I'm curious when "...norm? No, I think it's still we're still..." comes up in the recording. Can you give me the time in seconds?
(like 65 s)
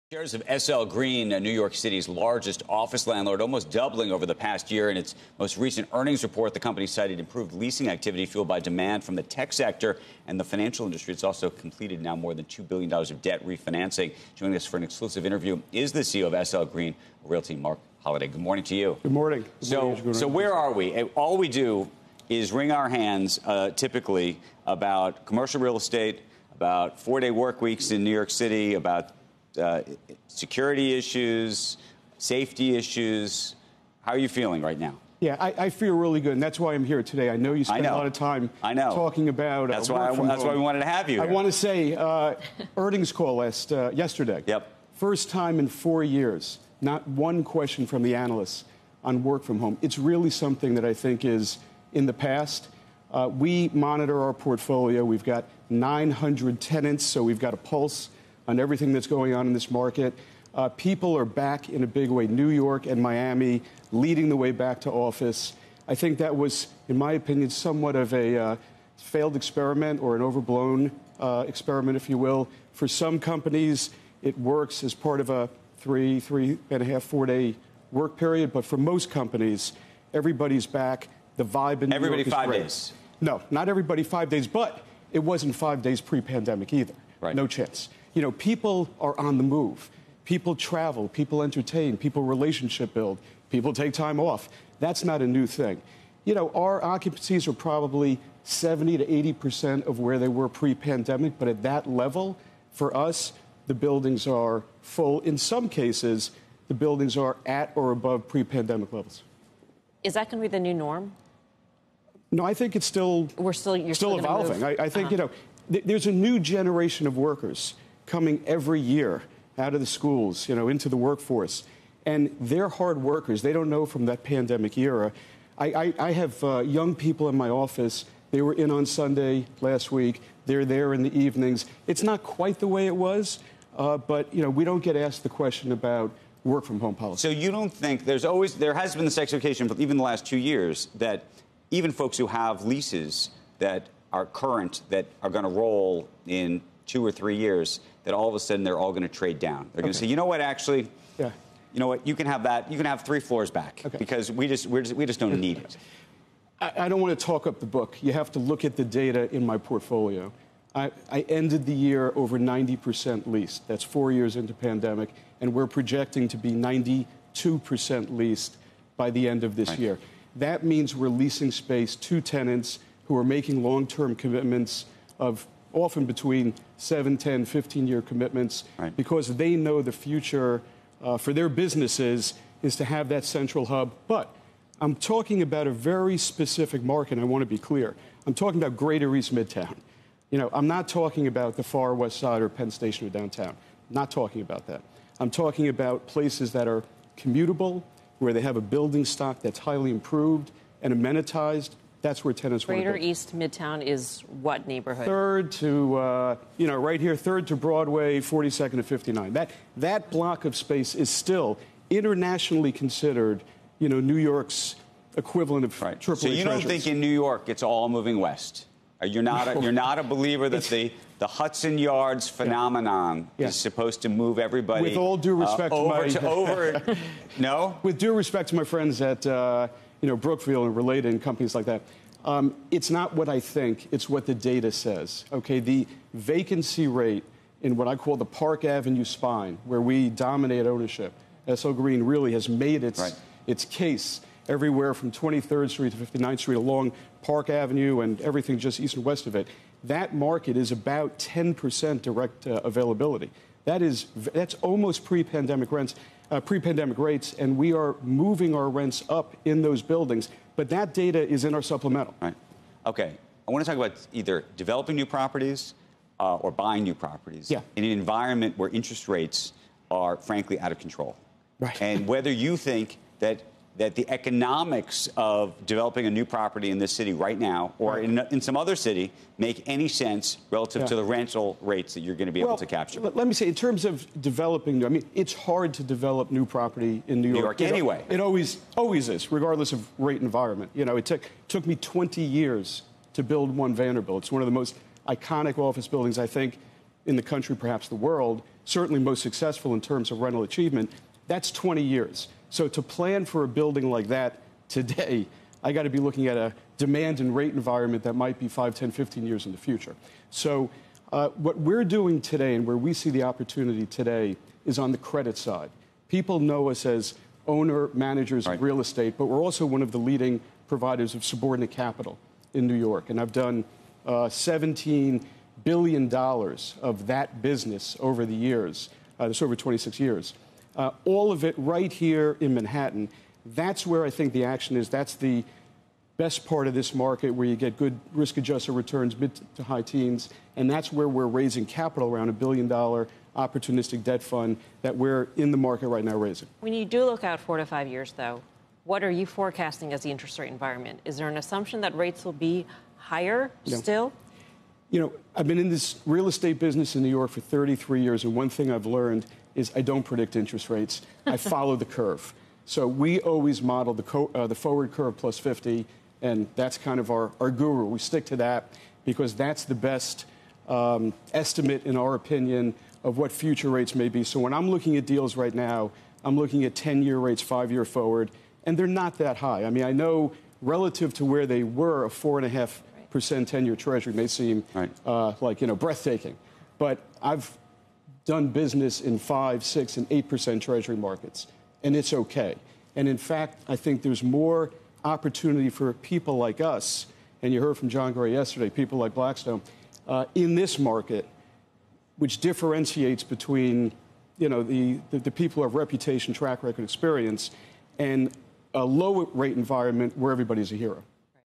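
110 s.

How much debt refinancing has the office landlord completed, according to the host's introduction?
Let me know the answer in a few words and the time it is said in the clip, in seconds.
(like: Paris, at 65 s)
more than $2 billion, at 12 s.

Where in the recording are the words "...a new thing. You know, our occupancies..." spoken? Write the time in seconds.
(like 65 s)
95 s.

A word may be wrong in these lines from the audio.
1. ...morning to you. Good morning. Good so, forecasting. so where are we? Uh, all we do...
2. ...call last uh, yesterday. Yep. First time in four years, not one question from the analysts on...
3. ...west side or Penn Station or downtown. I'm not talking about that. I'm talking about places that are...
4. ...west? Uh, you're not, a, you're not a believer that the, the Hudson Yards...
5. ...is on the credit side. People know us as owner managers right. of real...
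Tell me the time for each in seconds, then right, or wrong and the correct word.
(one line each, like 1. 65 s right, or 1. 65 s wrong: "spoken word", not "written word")
1. 18 s wrong: "morning", not "forecasting"
2. 43 s right
3. 191 s right
4. 218 s right
5. 314 s right.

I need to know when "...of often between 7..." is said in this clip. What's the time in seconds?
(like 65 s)
175 s.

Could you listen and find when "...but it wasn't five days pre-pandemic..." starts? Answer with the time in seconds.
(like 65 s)
84 s.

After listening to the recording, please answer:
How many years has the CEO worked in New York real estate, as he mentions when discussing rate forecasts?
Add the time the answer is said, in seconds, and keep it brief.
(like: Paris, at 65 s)
33, at 357 s.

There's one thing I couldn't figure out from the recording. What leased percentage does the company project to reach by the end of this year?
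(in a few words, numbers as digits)
92%.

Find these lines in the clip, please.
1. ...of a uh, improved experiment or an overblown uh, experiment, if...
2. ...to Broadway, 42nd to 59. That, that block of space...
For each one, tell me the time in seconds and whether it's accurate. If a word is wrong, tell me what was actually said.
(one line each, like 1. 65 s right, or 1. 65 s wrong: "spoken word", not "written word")
1. 67 s wrong: "failed", not "improved"
2. 207 s right.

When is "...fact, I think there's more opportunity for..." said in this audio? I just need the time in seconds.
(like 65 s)
393 s.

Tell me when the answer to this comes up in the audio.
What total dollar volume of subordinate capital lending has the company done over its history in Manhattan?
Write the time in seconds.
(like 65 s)
324 s.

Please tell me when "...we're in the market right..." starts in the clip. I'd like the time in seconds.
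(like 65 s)
344 s.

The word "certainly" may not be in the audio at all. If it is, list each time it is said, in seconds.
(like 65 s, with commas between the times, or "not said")
298 s.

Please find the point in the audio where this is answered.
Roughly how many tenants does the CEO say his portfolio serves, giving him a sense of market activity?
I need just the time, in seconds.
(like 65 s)
55 s.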